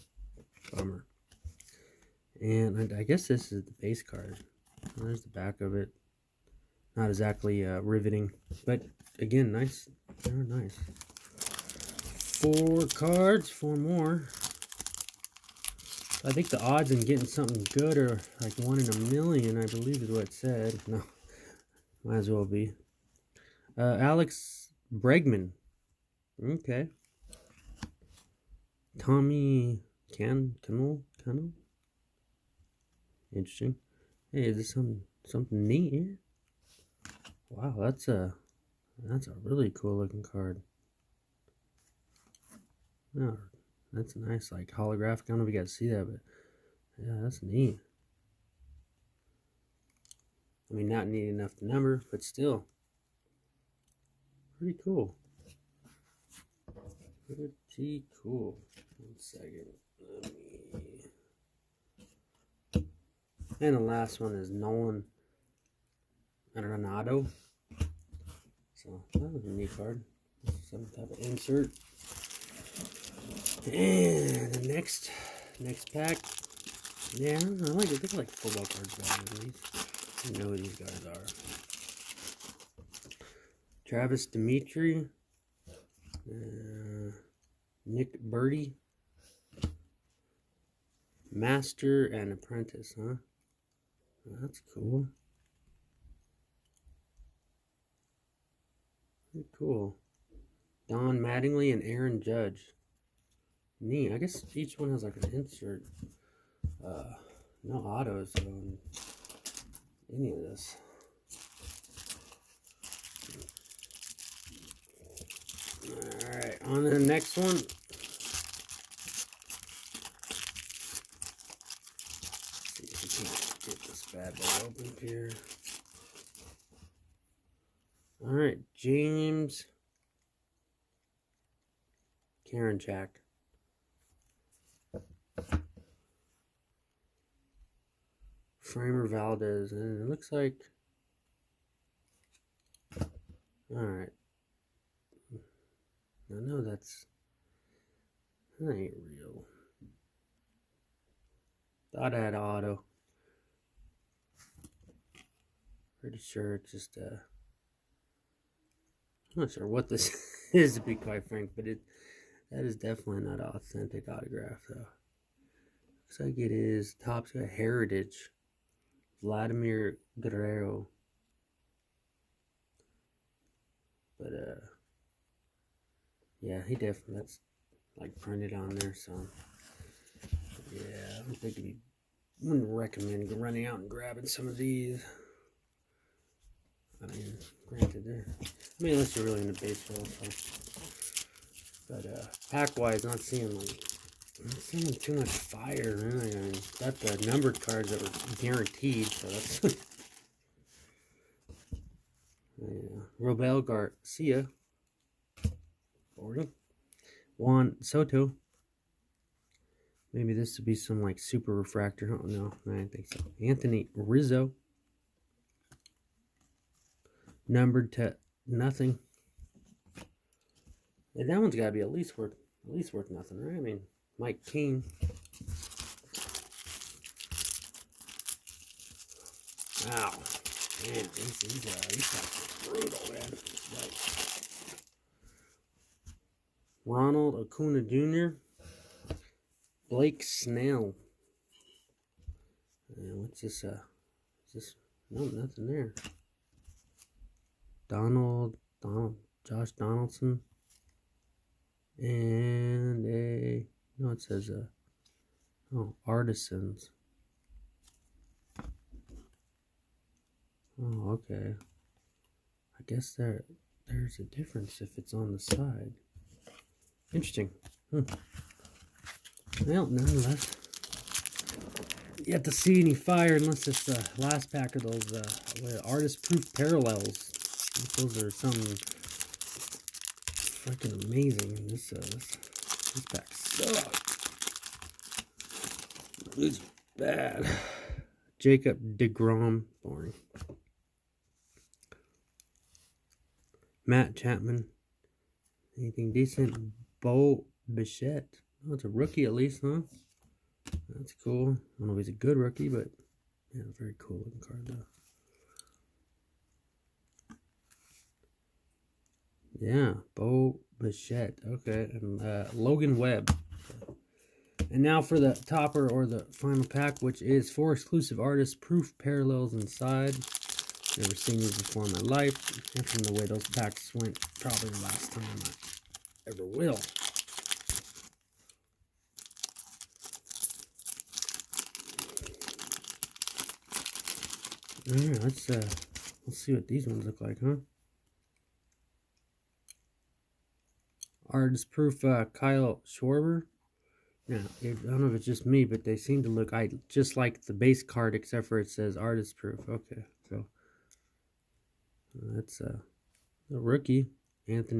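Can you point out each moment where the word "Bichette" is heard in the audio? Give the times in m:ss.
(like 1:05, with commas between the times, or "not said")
4:57, 5:10.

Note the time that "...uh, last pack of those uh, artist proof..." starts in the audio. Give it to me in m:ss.
4:33.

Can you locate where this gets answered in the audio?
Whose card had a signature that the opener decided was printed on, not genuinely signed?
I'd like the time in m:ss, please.
2:49.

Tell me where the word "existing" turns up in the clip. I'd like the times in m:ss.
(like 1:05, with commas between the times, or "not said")
not said.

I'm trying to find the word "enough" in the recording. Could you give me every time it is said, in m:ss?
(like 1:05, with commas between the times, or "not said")
0:51.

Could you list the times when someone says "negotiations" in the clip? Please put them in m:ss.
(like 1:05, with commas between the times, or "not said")
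not said.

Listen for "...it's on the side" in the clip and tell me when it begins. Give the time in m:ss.
4:24.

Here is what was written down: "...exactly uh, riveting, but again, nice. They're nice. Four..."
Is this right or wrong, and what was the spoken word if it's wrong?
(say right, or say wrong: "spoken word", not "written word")
right.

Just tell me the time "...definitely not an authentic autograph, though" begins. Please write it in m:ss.
2:42.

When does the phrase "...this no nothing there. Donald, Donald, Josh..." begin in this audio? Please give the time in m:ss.
4:04.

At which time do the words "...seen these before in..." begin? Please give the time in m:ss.
5:21.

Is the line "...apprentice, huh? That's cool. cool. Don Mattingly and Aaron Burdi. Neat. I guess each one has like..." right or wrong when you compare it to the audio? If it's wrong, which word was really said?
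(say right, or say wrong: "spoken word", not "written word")
wrong: "Judge", not "Burdi".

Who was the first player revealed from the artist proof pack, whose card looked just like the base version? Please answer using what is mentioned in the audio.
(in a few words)
Kyle Schwarber.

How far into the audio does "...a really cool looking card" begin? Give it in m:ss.
0:39.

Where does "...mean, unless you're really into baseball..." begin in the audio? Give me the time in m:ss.
3:08.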